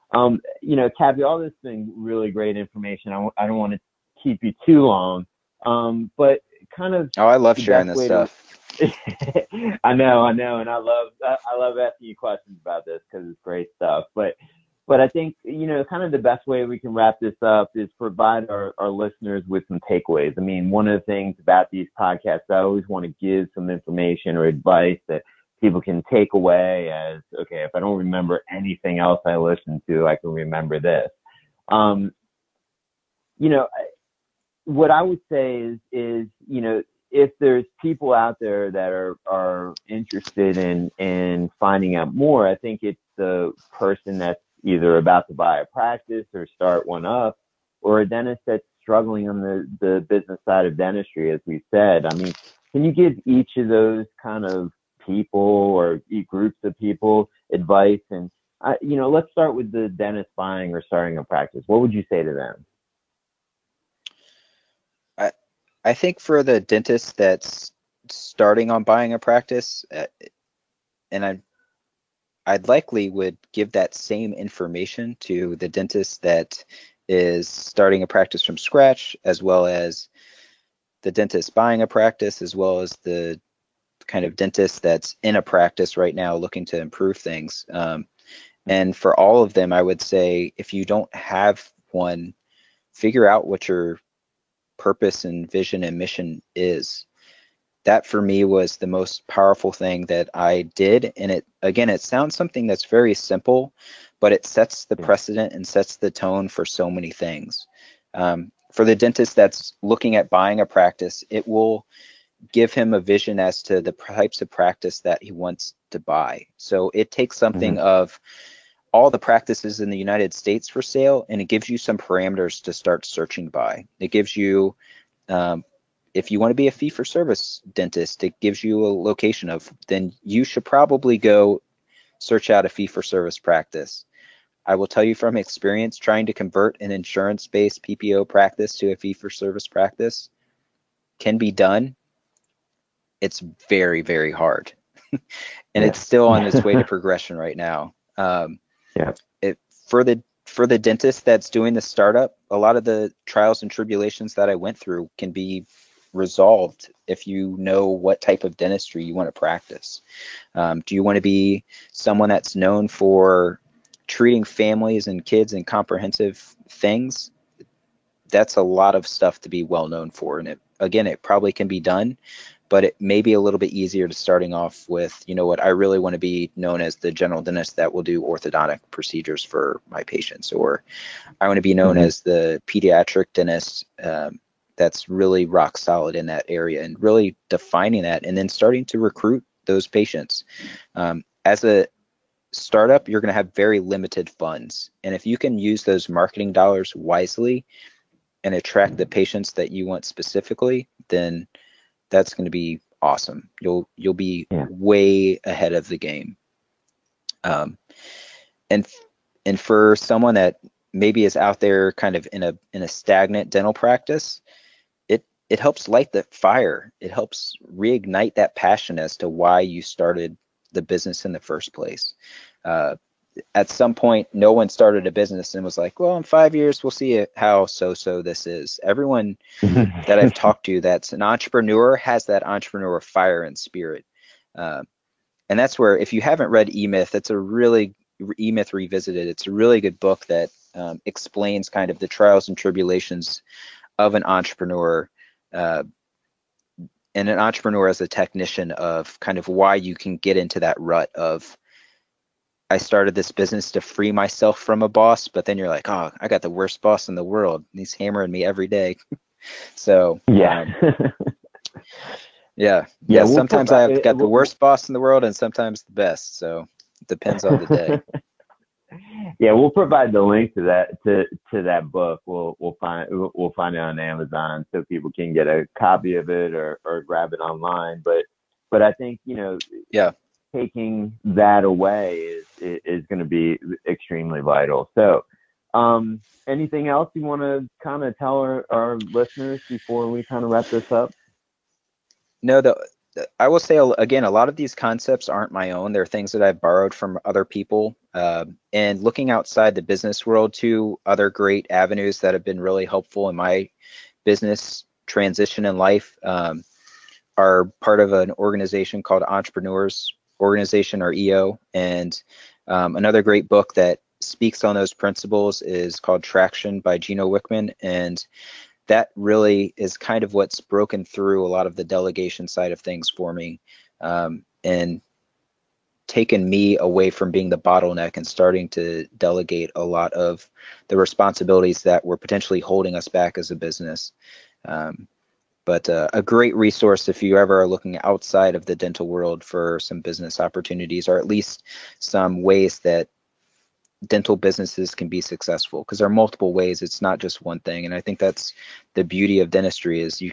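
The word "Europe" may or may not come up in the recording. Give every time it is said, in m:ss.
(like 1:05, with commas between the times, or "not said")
not said.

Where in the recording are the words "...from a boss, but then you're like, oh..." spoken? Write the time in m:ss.
4:14.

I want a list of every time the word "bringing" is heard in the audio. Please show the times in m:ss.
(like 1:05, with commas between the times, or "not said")
not said.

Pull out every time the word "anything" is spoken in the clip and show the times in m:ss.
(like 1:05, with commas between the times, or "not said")
0:28, 4:46.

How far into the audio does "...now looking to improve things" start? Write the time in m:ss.
1:26.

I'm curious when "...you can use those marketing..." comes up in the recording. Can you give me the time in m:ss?
3:15.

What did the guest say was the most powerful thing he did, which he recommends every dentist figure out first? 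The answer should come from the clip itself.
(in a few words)
purpose and vision and mission.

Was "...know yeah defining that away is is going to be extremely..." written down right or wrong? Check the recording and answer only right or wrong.
wrong.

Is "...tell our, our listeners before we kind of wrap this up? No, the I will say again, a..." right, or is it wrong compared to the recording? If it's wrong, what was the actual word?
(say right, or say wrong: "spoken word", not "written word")
right.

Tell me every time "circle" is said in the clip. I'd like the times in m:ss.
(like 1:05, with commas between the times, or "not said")
not said.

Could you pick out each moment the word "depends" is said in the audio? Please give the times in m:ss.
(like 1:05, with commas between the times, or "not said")
4:27.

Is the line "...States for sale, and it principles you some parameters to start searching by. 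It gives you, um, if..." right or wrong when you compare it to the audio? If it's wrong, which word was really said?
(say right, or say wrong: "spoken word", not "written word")
wrong: "gives", not "principles".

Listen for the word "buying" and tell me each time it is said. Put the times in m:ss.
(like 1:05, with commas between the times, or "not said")
1:00, 1:08, 1:21, 1:50.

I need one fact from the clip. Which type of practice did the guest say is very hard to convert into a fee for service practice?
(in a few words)
insurance based PPO practice.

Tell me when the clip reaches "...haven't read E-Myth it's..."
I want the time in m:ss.
3:56.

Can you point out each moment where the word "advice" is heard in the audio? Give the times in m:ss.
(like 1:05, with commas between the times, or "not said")
0:24, 0:57.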